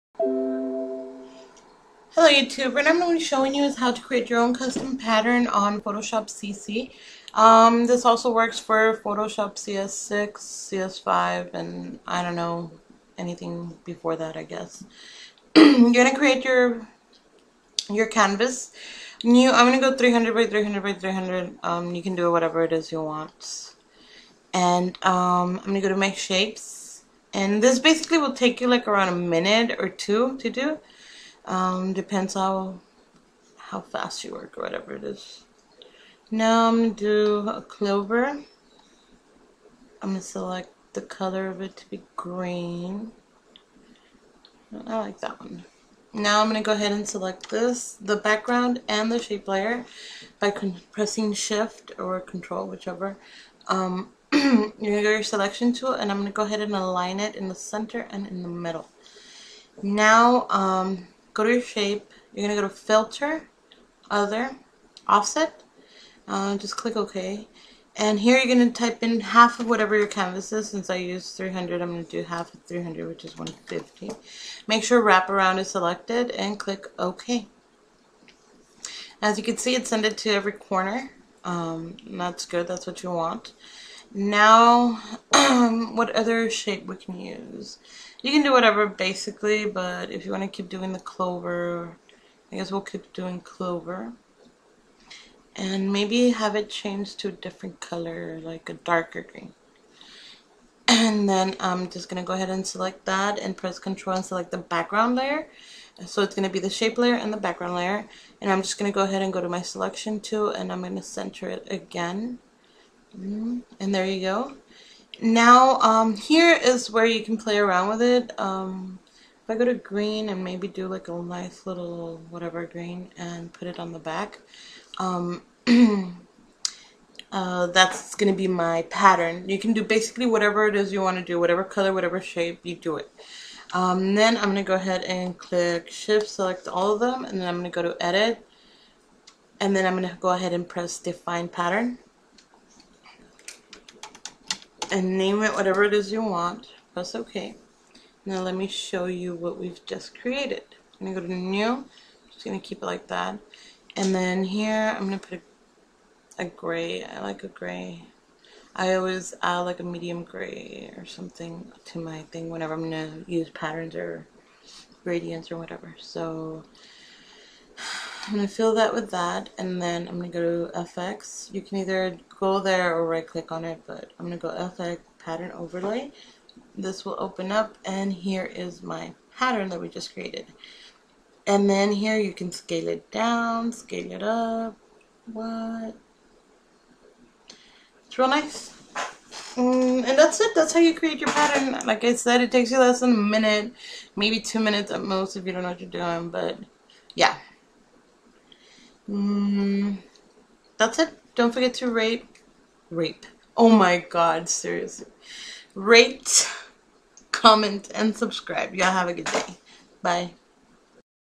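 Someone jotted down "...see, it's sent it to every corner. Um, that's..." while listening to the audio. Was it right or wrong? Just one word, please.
right.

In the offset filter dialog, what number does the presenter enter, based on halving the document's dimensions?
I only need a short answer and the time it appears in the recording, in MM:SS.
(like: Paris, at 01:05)
150, at 01:13.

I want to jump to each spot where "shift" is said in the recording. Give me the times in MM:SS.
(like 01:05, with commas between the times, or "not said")
00:51, 02:15.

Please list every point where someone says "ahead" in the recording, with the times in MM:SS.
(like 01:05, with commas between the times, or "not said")
00:46, 00:56, 01:42, 01:49, 02:14, 02:20.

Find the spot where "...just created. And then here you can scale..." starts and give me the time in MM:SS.
02:59.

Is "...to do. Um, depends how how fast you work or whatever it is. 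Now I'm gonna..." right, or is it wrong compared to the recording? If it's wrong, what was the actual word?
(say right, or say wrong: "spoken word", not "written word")
right.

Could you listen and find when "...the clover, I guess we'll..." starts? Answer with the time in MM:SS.
01:30.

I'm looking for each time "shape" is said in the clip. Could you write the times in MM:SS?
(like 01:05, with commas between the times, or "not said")
00:26, 00:49, 01:01, 01:26, 01:46, 02:12.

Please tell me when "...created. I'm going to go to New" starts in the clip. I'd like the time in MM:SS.
02:30.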